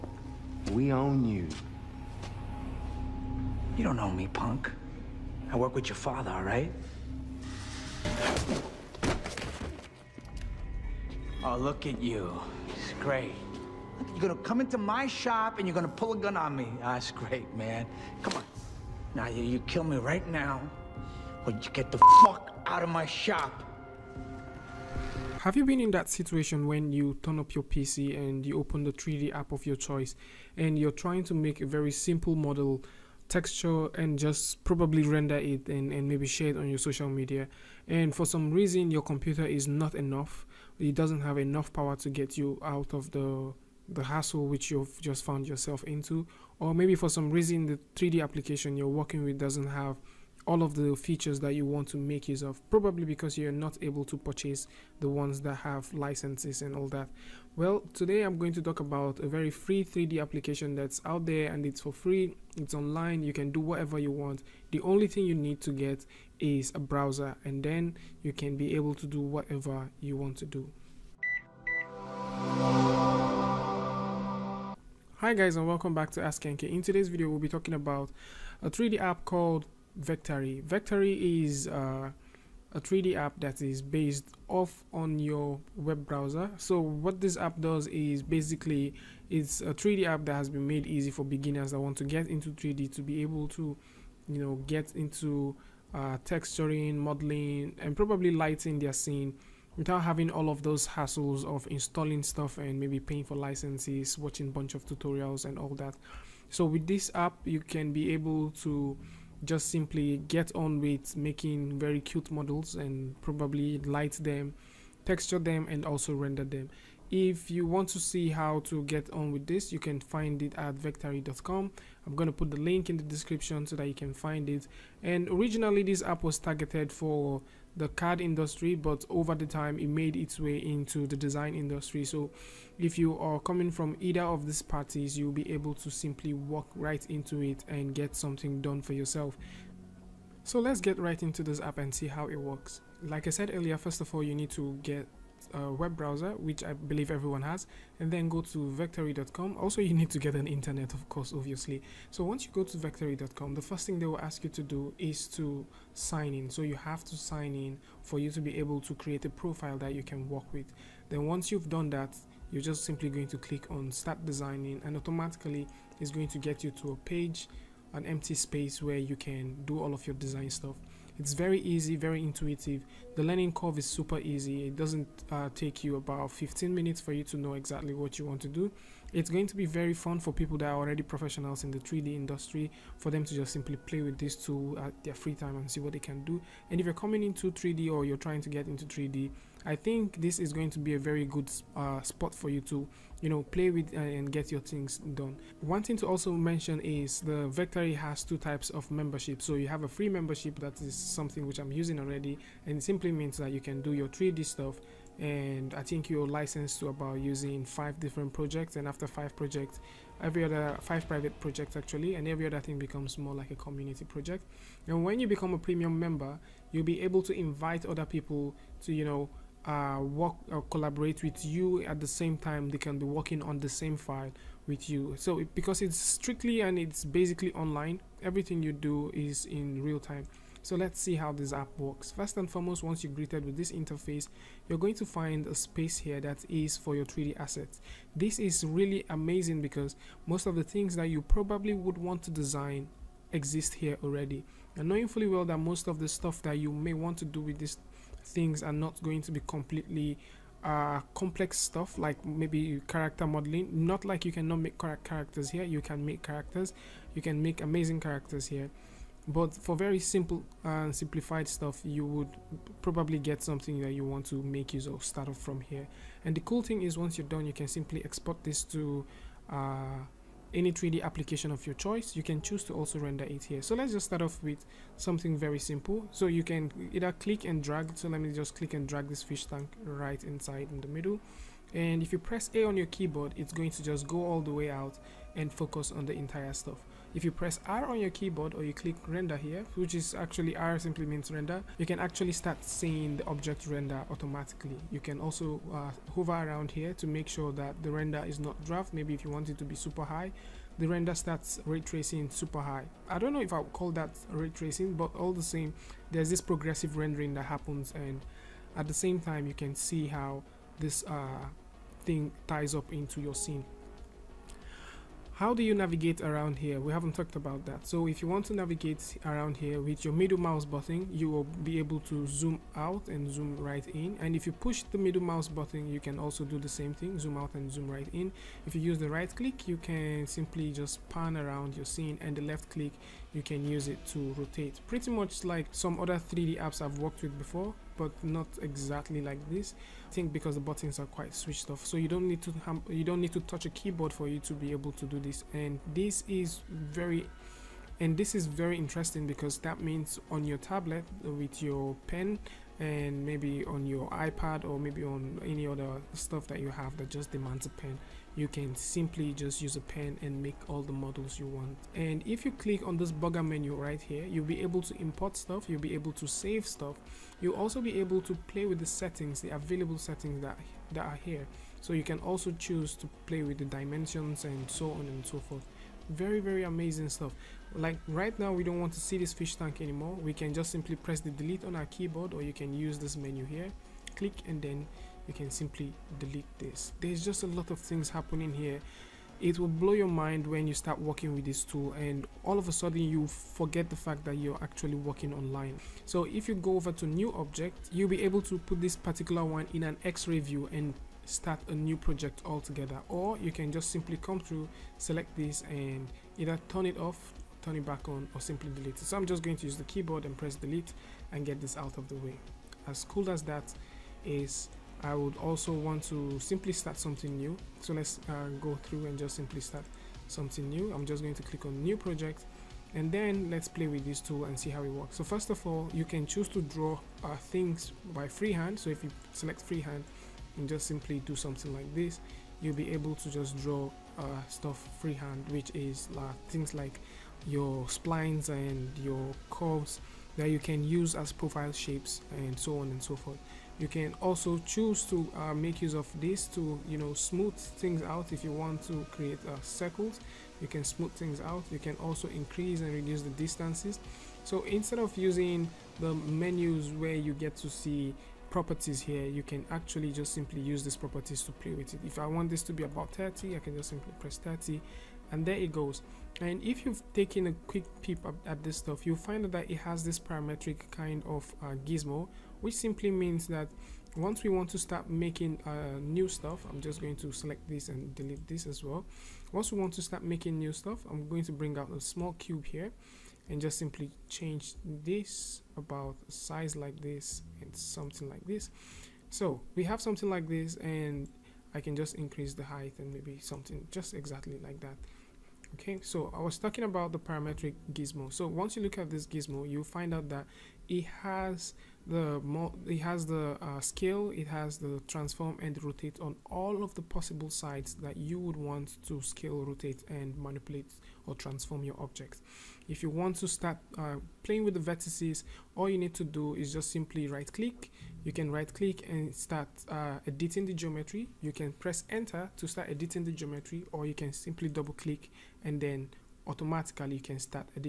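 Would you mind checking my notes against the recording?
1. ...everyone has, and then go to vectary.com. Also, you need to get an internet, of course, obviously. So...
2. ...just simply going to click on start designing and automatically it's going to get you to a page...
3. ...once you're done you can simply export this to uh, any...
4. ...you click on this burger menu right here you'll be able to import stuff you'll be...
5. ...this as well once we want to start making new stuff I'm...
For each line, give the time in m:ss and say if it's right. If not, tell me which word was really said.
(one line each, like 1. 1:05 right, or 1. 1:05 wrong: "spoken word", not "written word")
1. 2:27 right
2. 2:42 right
3. 4:26 right
4. 6:02 right
5. 7:58 right.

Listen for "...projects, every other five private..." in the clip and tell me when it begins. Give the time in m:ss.
3:29.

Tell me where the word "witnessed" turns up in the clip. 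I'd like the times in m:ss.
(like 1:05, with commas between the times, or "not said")
not said.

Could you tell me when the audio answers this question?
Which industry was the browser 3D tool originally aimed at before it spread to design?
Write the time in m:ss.
2:07.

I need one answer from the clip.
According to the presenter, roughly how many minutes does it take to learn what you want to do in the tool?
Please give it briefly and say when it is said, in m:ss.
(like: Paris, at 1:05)
15, at 2:56.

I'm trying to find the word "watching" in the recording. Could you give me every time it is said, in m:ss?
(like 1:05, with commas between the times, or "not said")
1:44.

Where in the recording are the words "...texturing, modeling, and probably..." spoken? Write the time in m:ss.
1:36.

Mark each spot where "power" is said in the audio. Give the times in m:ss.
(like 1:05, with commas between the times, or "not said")
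0:41.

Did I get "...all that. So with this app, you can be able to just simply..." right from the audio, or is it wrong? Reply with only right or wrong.
right.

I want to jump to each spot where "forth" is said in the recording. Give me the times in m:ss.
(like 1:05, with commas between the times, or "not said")
6:15, 7:23.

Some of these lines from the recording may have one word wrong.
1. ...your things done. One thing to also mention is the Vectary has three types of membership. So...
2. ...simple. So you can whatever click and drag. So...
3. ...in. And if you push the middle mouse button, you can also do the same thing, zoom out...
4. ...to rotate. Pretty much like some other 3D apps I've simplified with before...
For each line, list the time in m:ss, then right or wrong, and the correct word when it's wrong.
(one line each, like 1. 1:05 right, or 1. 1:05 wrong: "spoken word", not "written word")
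1. 3:14 wrong: "two", not "three"
2. 4:35 wrong: "either", not "whatever"
3. 5:23 right
4. 5:34 wrong: "worked", not "simplified".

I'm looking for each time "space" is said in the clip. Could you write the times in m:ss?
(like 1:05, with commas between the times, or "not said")
2:48, 3:55.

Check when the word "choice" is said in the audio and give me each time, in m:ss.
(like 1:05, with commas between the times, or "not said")
0:29, 4:31.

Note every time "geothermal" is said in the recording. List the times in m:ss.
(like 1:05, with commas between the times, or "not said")
not said.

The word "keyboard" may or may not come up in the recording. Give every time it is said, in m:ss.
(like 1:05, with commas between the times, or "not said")
4:42, 4:48, 5:43, 6:21, 6:49.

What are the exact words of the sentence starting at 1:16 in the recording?
In today's video we'll be talking about a 3D app called Vectary.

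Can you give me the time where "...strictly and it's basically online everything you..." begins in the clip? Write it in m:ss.
3:45.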